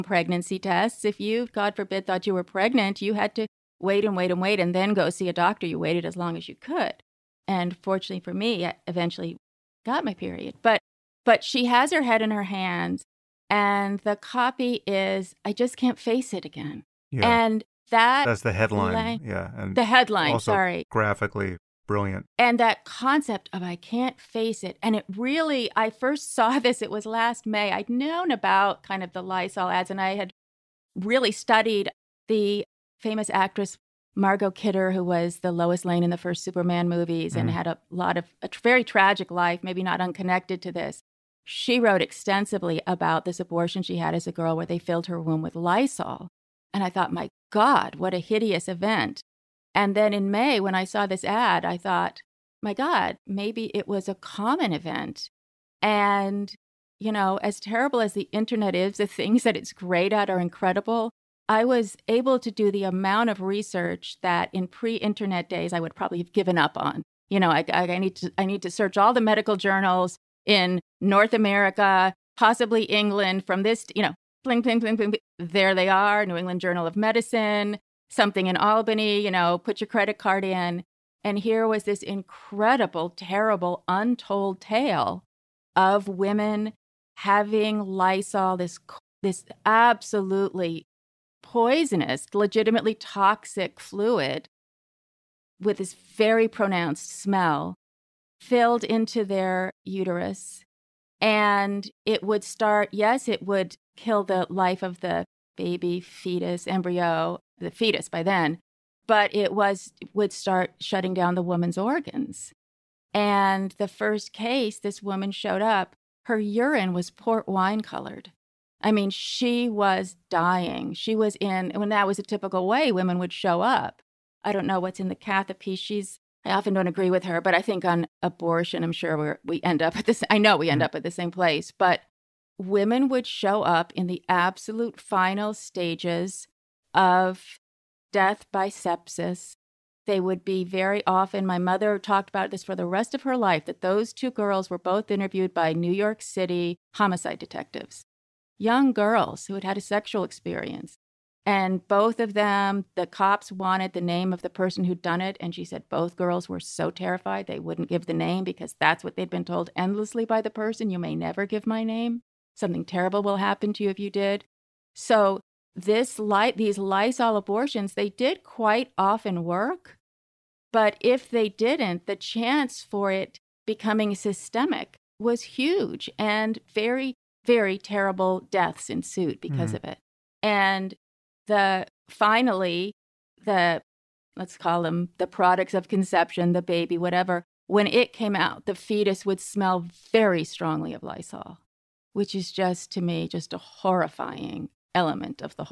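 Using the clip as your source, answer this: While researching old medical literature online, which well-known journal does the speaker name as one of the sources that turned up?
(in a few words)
New England Journal of Medicine.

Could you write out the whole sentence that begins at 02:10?
up at the same place, but women would show up in the absolute final stages of death by sepsis.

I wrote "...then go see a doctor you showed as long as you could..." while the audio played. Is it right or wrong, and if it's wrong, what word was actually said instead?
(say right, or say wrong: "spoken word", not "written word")
wrong: "waited", not "showed".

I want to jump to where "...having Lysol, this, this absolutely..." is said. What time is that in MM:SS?
01:27.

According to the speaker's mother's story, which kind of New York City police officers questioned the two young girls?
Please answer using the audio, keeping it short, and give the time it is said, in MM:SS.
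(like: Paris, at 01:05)
Homicide detectives, at 02:26.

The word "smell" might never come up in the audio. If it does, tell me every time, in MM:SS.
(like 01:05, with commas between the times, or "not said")
01:37, 03:09.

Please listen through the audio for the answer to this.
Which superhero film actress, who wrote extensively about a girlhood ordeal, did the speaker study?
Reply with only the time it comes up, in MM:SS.
00:34.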